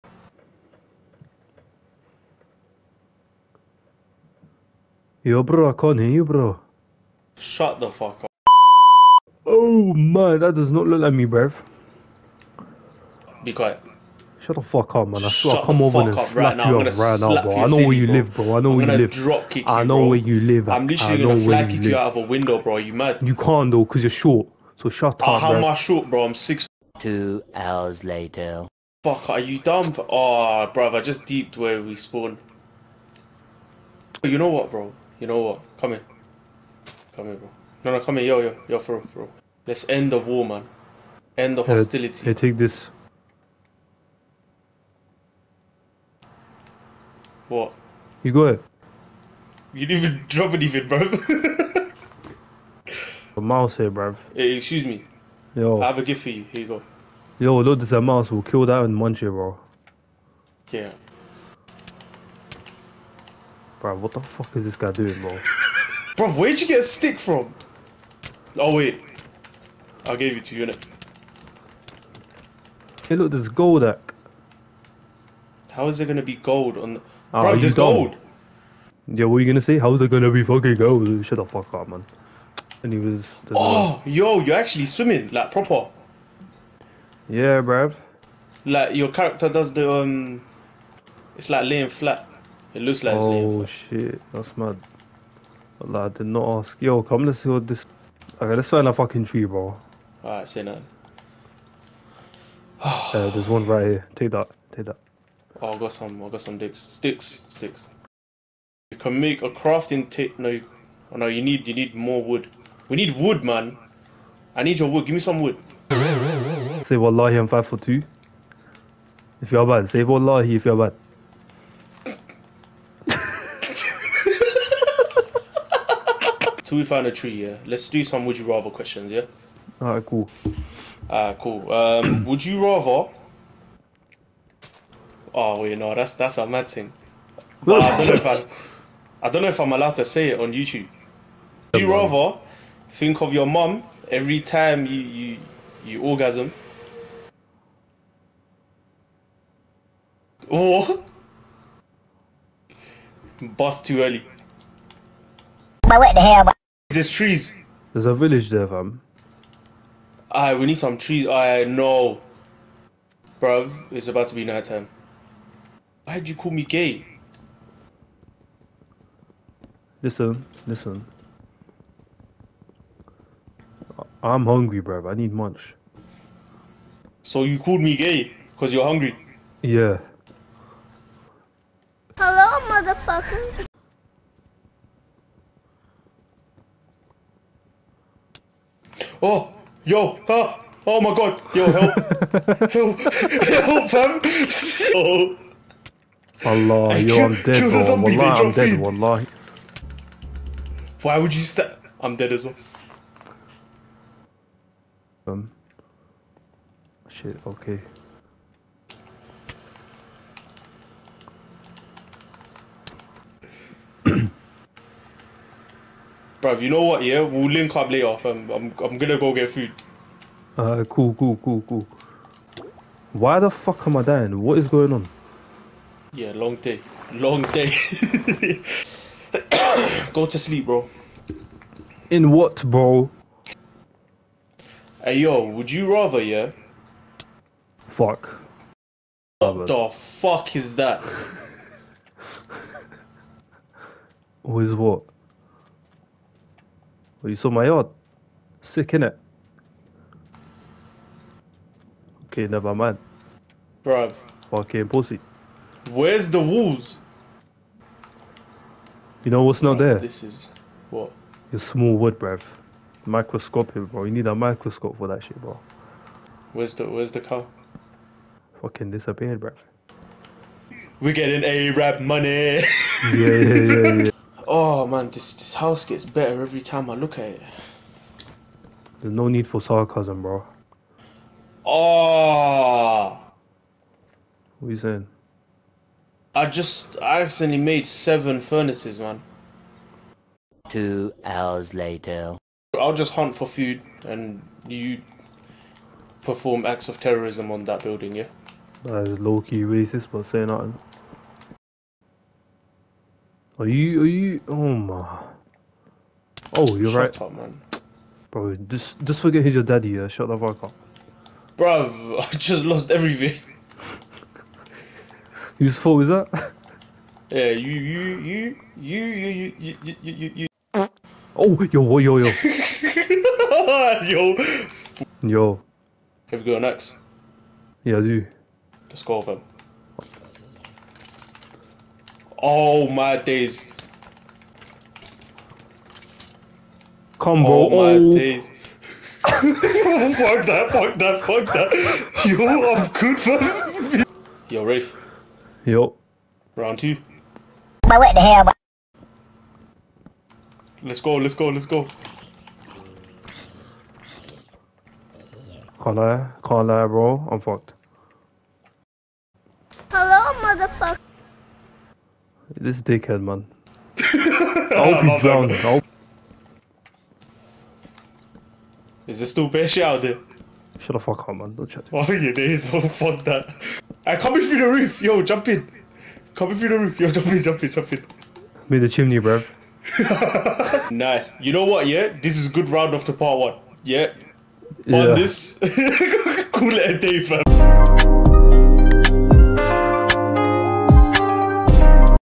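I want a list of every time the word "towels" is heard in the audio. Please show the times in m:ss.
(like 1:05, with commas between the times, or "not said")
not said.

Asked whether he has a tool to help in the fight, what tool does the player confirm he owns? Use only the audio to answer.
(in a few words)
An axe.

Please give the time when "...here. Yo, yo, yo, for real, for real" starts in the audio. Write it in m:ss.
0:38.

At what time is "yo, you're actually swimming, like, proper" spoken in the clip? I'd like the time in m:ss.
1:24.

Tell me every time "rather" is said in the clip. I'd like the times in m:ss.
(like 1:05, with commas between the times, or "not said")
2:08, 2:12, 2:21, 3:55.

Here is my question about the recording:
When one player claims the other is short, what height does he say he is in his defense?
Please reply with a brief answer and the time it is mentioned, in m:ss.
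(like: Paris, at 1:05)
6, at 0:26.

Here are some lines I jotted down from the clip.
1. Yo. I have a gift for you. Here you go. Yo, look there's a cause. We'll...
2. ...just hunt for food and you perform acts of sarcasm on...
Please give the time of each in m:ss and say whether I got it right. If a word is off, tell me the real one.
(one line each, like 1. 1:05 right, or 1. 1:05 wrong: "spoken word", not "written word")
1. 0:55 wrong: "mouse", not "cause"
2. 4:52 wrong: "terrorism", not "sarcasm".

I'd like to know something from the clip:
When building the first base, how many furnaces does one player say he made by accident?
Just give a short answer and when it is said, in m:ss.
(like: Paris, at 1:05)
7, at 4:47.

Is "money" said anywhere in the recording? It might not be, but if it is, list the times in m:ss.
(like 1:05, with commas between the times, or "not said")
4:32.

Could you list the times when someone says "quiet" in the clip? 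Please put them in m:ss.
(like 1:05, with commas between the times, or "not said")
0:13.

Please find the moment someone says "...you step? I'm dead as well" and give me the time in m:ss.
3:21.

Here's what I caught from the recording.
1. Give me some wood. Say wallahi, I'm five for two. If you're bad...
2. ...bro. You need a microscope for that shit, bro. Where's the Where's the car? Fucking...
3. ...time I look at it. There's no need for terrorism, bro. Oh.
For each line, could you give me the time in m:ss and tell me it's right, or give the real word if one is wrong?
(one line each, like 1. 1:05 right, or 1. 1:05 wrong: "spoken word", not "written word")
1. 1:55 right
2. 4:23 right
3. 4:36 wrong: "sarcasm", not "terrorism".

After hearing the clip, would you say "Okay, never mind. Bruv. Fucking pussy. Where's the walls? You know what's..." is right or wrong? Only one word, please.
right.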